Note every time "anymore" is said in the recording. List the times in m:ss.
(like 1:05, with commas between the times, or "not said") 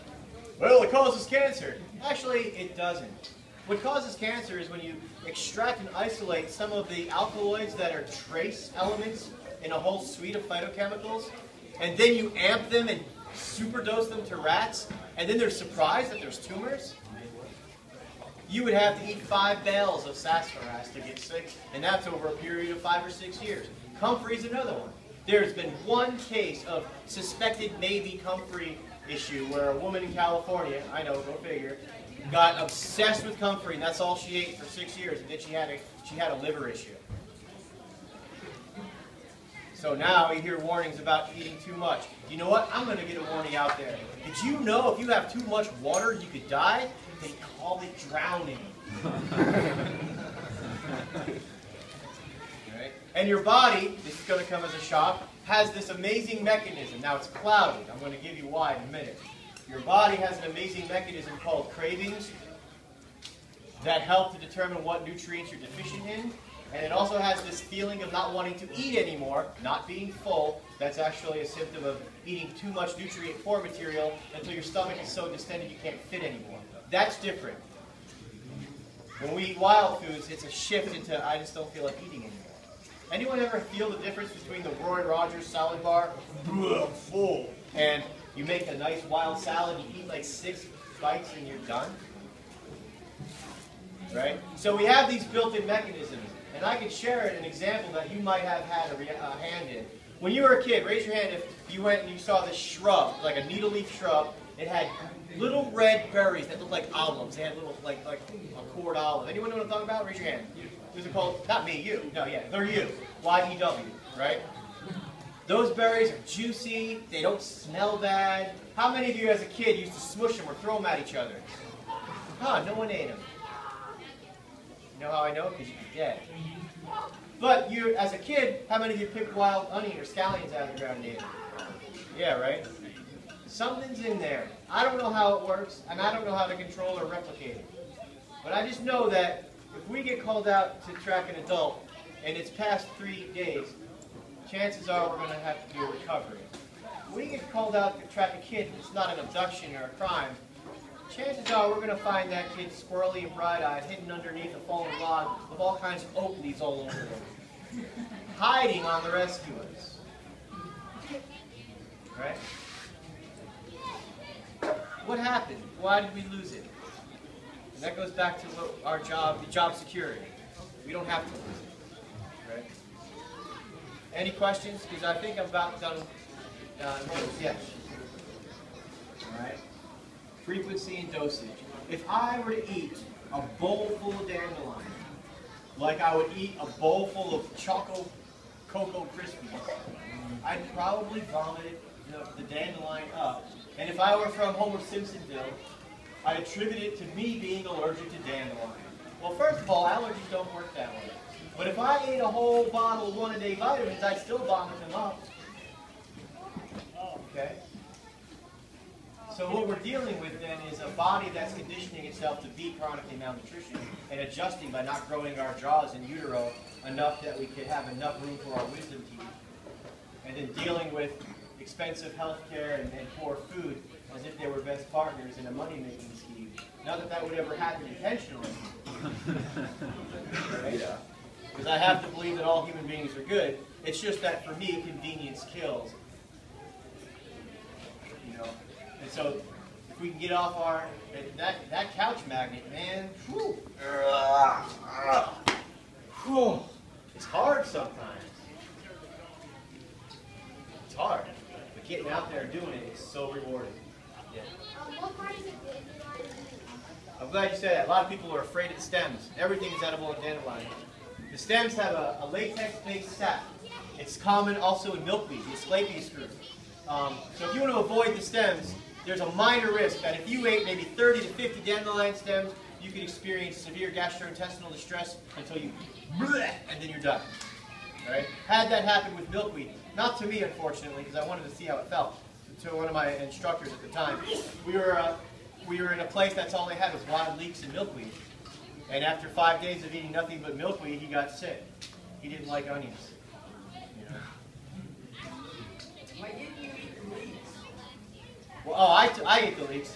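1:08, 1:16, 1:22.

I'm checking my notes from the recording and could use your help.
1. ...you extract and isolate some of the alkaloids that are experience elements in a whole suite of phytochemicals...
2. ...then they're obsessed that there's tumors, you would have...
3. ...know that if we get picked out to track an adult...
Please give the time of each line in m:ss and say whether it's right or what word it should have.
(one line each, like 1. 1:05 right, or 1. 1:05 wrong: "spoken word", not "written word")
1. 0:04 wrong: "trace", not "experience"
2. 0:15 wrong: "surprised", not "obsessed"
3. 2:18 wrong: "called", not "picked".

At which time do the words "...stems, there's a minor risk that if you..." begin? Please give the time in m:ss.
4:28.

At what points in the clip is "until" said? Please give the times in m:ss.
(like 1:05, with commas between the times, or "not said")
1:14, 4:35.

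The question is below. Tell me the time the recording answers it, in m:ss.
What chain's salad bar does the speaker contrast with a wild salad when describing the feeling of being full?
1:24.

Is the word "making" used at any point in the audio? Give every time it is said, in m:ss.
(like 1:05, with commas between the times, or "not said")
3:45.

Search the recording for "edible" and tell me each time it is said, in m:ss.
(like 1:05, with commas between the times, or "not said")
4:19.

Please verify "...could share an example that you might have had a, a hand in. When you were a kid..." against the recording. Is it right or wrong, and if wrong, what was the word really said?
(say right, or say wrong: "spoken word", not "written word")
right.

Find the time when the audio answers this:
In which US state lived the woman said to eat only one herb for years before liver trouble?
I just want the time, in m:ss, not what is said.
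0:30.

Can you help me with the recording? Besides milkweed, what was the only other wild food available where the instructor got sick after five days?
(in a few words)
wild leeks.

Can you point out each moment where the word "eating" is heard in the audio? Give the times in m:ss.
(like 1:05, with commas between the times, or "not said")
0:41, 1:12, 1:22, 4:49.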